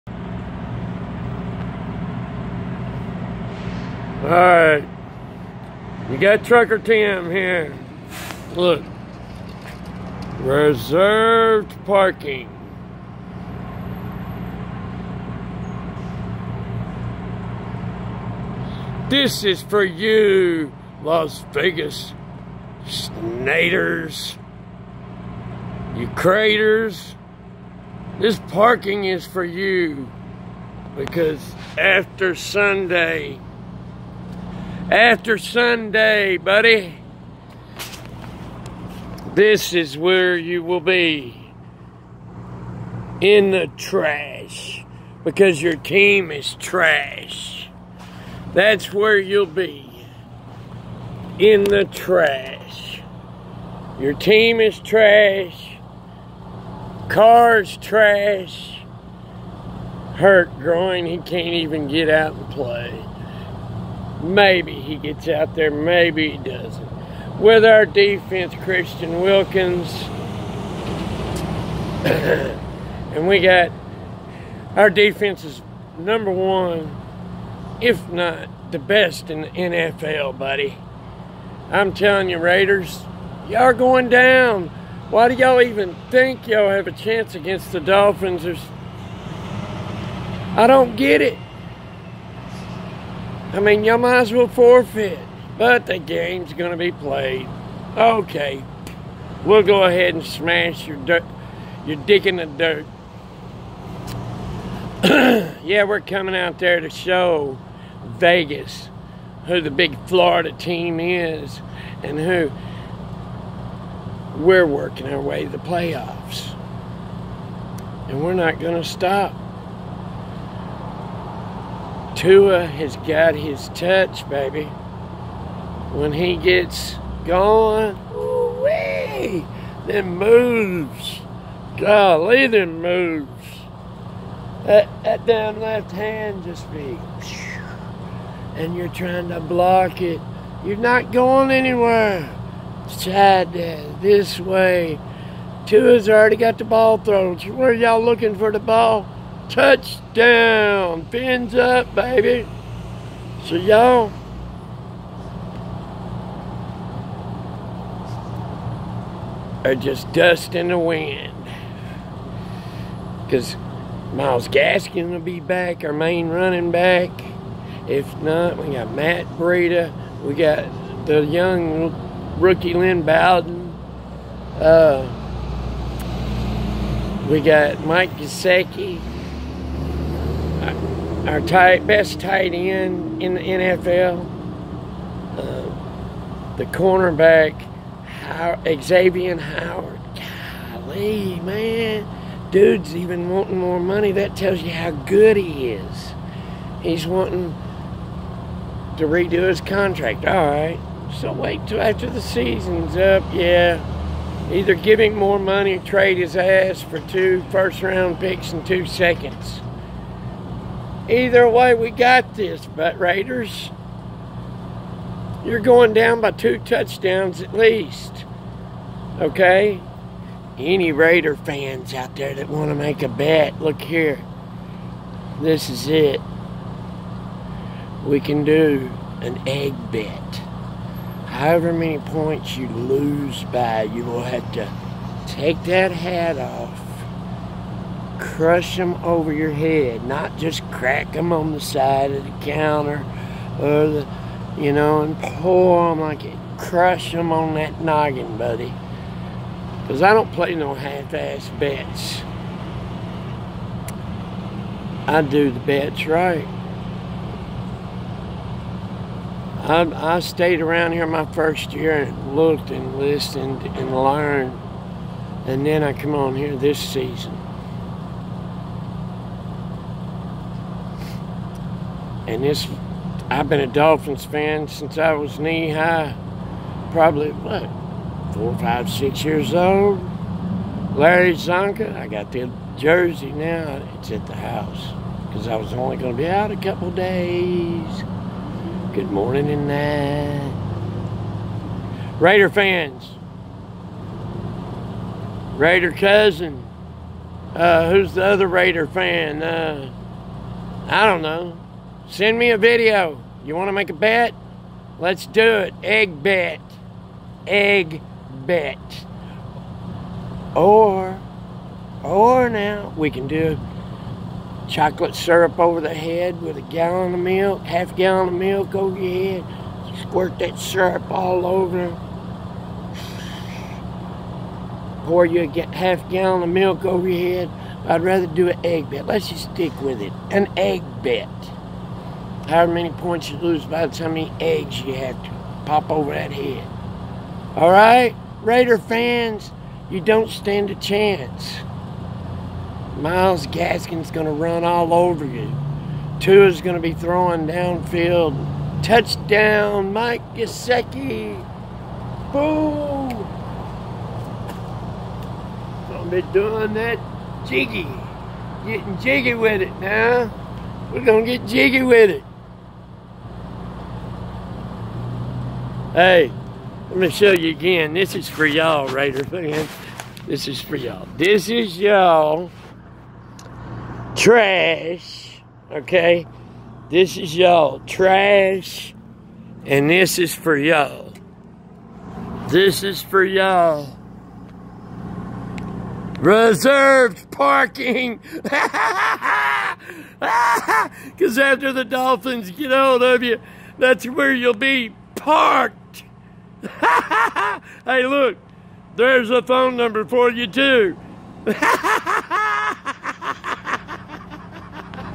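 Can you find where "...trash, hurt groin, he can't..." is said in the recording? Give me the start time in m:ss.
0:57.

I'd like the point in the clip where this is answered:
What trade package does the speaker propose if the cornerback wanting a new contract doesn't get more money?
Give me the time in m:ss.
3:27.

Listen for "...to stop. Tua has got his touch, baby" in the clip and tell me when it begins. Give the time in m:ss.
1:58.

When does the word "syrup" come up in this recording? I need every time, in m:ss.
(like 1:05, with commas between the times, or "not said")
5:15, 5:20.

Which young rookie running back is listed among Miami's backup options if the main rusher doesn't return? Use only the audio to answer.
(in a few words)
Lynn Bowden.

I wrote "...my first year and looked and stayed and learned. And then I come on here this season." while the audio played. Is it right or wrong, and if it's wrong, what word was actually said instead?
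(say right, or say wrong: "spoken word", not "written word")
wrong: "listened", not "stayed".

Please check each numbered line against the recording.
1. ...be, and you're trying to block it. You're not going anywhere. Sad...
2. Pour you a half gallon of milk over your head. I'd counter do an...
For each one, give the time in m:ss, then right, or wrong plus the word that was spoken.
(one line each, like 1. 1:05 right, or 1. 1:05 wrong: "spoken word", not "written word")
1. 2:16 right
2. 5:25 wrong: "rather", not "counter".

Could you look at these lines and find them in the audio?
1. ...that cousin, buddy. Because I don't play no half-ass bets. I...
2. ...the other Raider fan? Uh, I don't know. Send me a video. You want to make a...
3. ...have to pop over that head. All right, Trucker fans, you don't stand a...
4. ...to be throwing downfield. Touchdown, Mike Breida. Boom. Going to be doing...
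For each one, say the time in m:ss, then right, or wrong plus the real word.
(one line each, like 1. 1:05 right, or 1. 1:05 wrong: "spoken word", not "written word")
1. 4:07 wrong: "noggin", not "cousin"
2. 4:58 right
3. 5:34 wrong: "Raider", not "Trucker"
4. 5:46 wrong: "Gesicki", not "Breida".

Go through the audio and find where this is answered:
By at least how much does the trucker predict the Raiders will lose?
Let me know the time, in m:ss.
3:36.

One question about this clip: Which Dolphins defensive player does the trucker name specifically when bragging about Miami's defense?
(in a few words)
Christian Wilkins.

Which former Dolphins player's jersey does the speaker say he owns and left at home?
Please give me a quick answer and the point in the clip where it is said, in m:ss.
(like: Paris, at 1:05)
Larry Csonka, at 4:40.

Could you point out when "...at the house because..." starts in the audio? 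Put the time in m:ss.
4:44.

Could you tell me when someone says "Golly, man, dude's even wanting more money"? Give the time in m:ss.
3:10.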